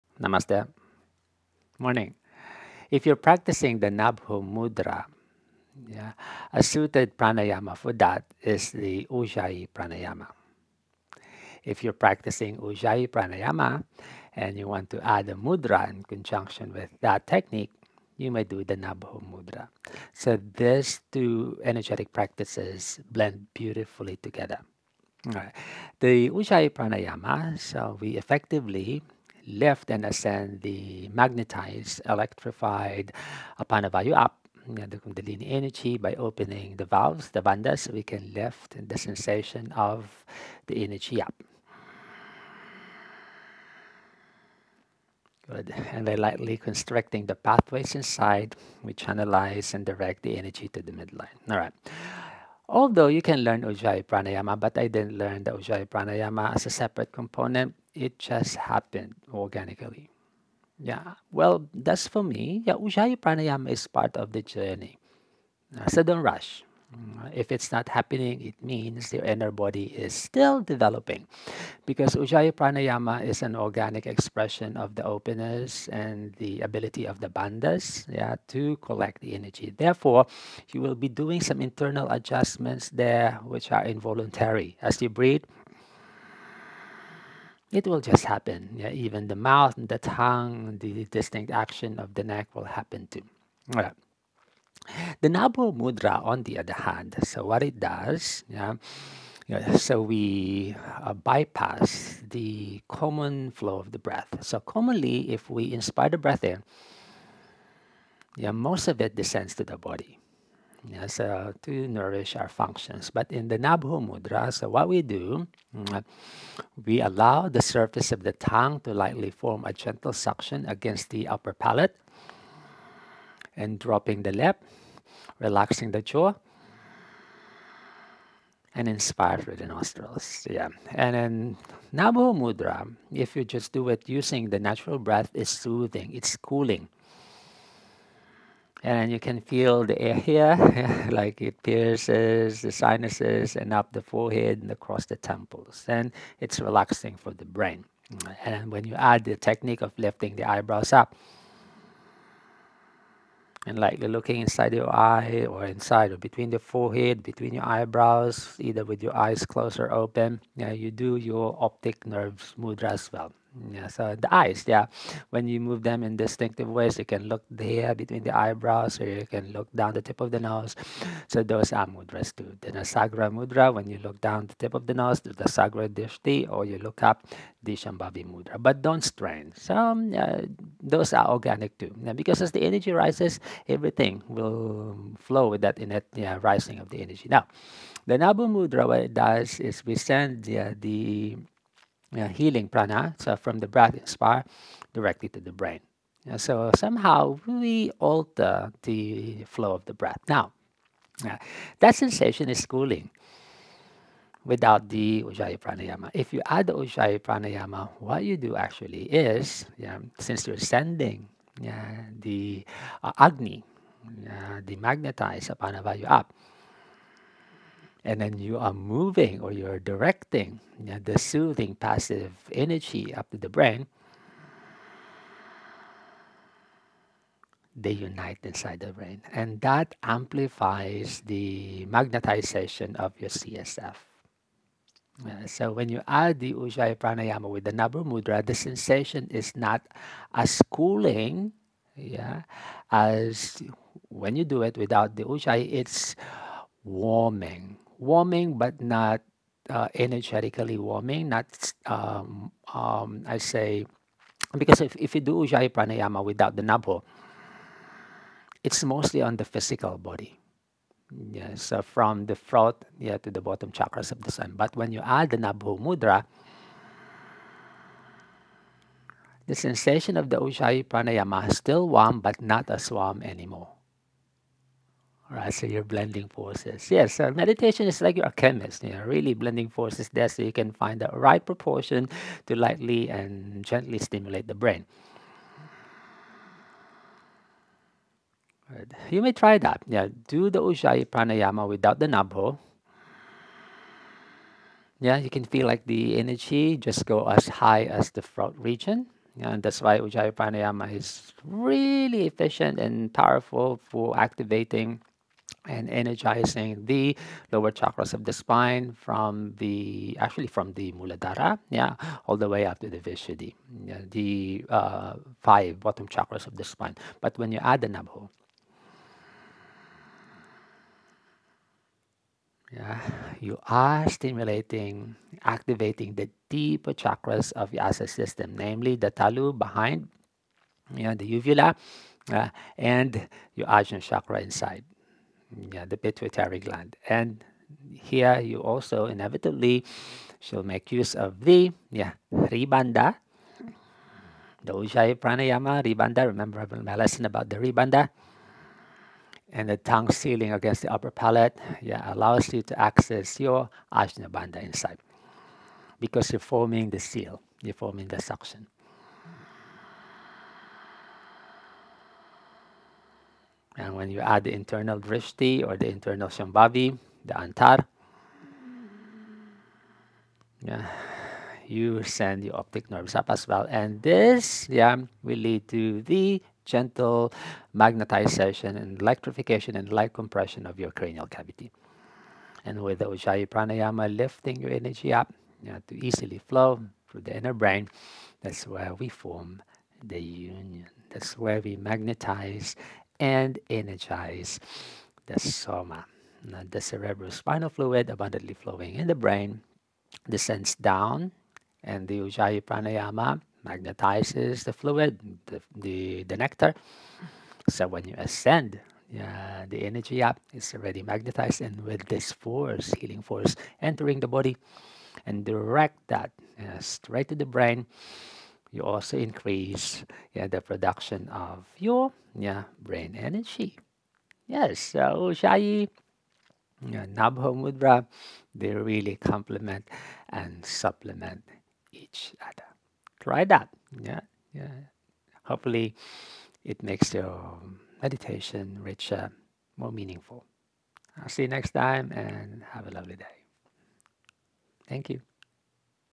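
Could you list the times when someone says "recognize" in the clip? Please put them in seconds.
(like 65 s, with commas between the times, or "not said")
not said.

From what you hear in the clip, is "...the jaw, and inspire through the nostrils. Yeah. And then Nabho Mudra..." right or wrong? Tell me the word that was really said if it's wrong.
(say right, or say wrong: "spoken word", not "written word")
right.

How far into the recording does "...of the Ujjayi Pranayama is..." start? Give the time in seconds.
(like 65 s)
270 s.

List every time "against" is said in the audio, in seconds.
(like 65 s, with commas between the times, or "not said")
120 s, 350 s.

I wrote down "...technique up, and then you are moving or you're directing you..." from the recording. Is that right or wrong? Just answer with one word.
wrong.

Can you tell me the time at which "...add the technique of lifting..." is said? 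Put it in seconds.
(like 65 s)
148 s.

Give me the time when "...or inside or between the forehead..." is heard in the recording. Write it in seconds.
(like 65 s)
155 s.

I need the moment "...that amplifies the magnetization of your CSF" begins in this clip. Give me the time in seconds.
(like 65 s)
229 s.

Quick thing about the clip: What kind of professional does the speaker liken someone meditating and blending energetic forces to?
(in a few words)
A chemist.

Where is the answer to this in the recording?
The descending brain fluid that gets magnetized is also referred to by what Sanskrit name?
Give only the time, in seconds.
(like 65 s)
395 s.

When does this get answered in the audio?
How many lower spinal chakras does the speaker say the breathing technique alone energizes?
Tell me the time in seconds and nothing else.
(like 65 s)
315 s.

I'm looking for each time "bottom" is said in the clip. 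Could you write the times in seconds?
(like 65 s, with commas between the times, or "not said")
263 s, 315 s.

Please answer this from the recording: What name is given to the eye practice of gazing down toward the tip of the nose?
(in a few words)
Nasagra Drishti.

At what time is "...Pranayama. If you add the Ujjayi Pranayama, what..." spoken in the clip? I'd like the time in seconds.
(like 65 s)
205 s.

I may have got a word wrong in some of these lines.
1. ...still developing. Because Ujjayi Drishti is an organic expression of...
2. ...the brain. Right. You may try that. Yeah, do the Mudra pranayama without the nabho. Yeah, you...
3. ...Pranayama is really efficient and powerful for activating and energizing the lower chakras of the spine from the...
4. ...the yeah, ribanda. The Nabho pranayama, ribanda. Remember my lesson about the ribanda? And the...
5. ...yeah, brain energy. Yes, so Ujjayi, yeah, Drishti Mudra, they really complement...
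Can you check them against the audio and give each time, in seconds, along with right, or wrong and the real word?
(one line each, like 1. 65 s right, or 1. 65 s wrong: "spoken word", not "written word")
1. 70 s wrong: "Pranayama", not "Drishti"
2. 284 s wrong: "Ujjayi", not "Mudra"
3. 300 s right
4. 341 s wrong: "Ujjayi", not "Nabho"
5. 422 s wrong: "Nabho", not "Drishti".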